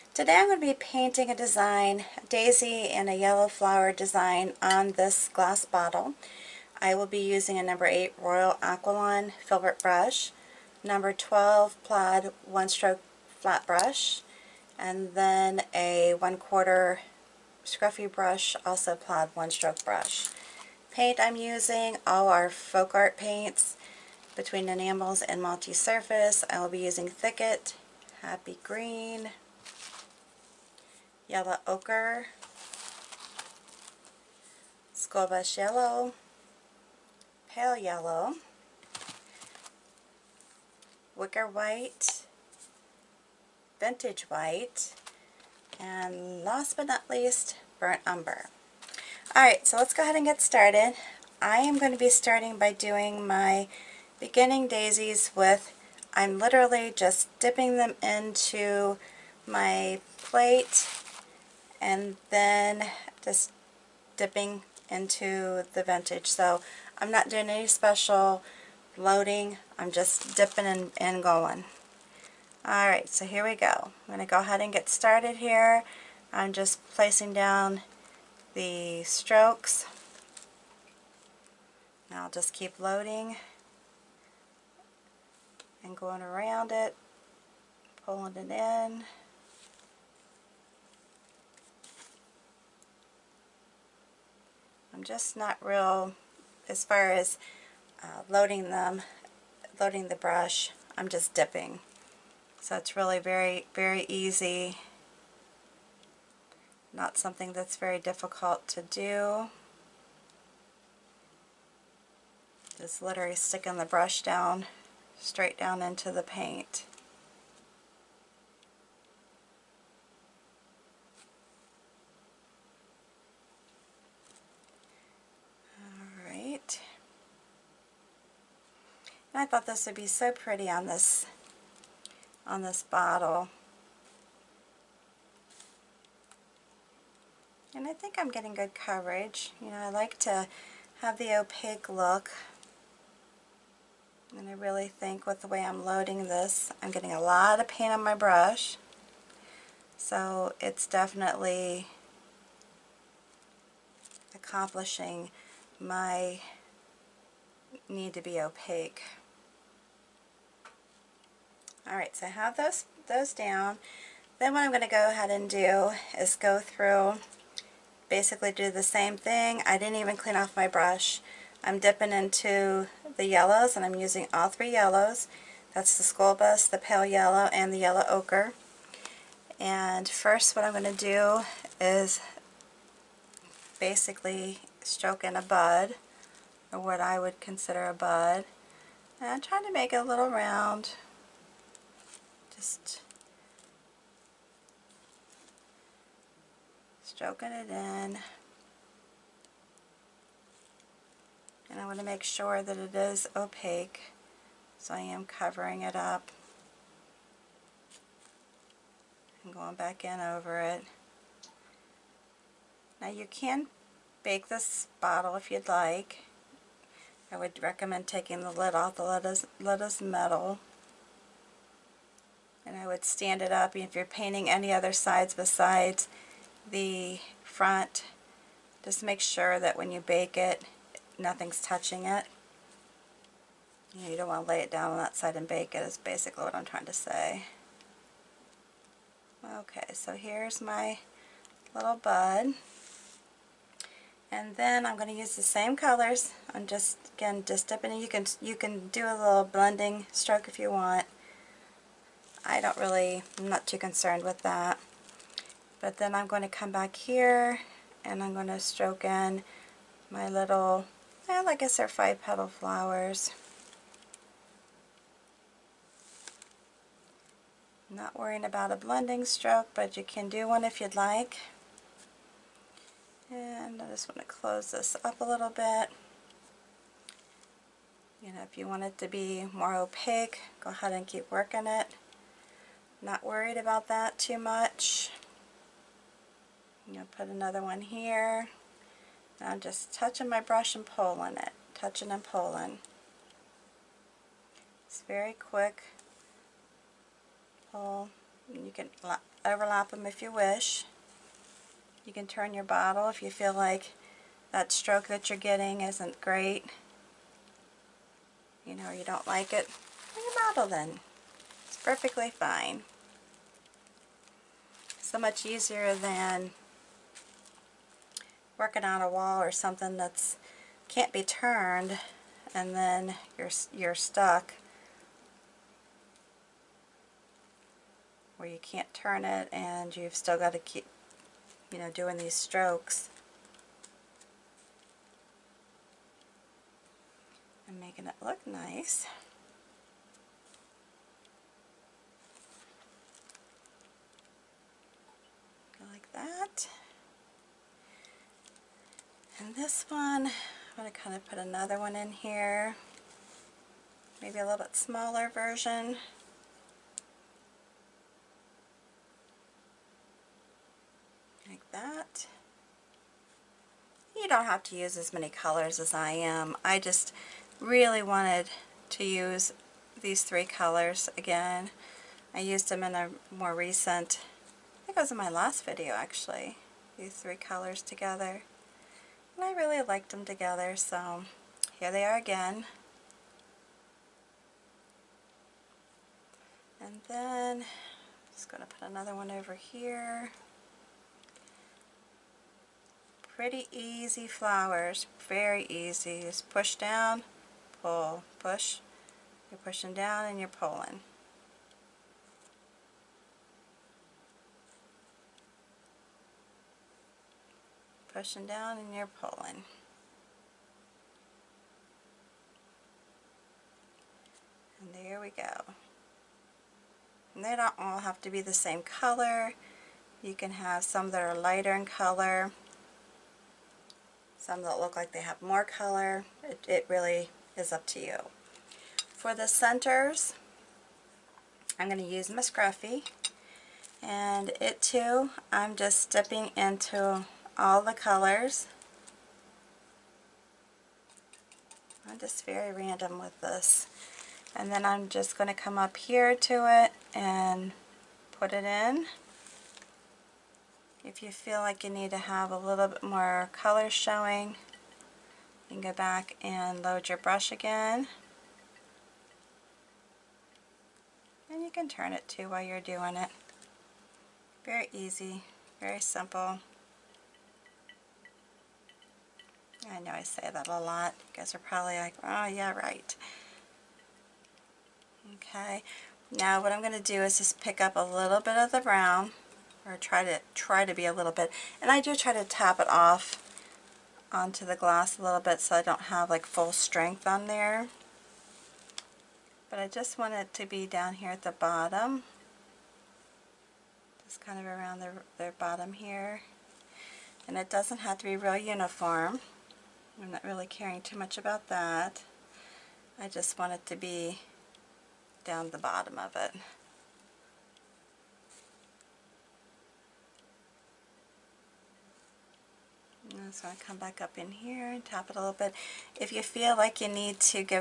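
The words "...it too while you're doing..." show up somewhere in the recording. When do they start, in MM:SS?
07:42.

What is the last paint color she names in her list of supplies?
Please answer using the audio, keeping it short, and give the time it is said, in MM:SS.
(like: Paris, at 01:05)
Burnt Umber, at 00:47.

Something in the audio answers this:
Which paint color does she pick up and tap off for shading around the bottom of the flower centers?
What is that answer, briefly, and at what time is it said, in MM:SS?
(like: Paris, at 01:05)
Brown, at 07:58.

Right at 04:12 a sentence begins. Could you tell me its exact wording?
I don't really, I'm not too concerned with that.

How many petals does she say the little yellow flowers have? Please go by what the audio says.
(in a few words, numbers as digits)
5.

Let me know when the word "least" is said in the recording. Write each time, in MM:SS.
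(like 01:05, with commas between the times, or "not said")
00:47.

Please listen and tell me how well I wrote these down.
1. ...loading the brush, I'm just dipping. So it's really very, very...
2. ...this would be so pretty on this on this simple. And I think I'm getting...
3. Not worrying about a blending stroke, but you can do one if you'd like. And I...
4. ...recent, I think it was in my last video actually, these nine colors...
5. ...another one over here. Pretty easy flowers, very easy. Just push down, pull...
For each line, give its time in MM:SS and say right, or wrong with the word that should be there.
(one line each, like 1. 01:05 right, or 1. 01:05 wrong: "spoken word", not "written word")
1. 01:39 right
2. 02:09 wrong: "bottle", not "simple"
3. 04:27 right
4. 06:13 wrong: "three", not "nine"
5. 06:28 right.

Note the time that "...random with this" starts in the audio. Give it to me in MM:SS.
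07:22.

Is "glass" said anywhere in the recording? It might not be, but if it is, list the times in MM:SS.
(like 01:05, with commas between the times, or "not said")
00:05, 08:04.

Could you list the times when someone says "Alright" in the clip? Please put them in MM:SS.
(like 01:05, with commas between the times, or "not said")
00:49, 01:12, 02:06, 02:41.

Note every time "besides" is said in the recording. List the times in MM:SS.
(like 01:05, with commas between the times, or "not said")
03:45.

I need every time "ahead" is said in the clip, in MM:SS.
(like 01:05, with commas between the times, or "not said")
00:50, 01:14, 02:45, 04:40.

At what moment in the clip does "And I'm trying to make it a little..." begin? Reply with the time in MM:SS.
03:09.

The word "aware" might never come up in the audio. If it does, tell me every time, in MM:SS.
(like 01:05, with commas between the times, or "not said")
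not said.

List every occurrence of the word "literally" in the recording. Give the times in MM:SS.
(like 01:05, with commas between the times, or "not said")
00:56, 01:53.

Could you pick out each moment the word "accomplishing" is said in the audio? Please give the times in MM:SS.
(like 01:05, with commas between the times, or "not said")
02:34.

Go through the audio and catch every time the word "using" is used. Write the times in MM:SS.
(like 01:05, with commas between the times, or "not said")
00:07, 00:21, 00:26, 02:53.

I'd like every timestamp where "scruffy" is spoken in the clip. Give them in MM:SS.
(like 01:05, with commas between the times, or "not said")
00:17, 07:12.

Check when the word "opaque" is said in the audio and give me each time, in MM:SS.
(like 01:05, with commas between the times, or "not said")
02:21, 02:38, 03:23, 04:39.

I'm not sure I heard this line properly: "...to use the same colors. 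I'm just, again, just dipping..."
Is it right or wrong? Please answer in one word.
right.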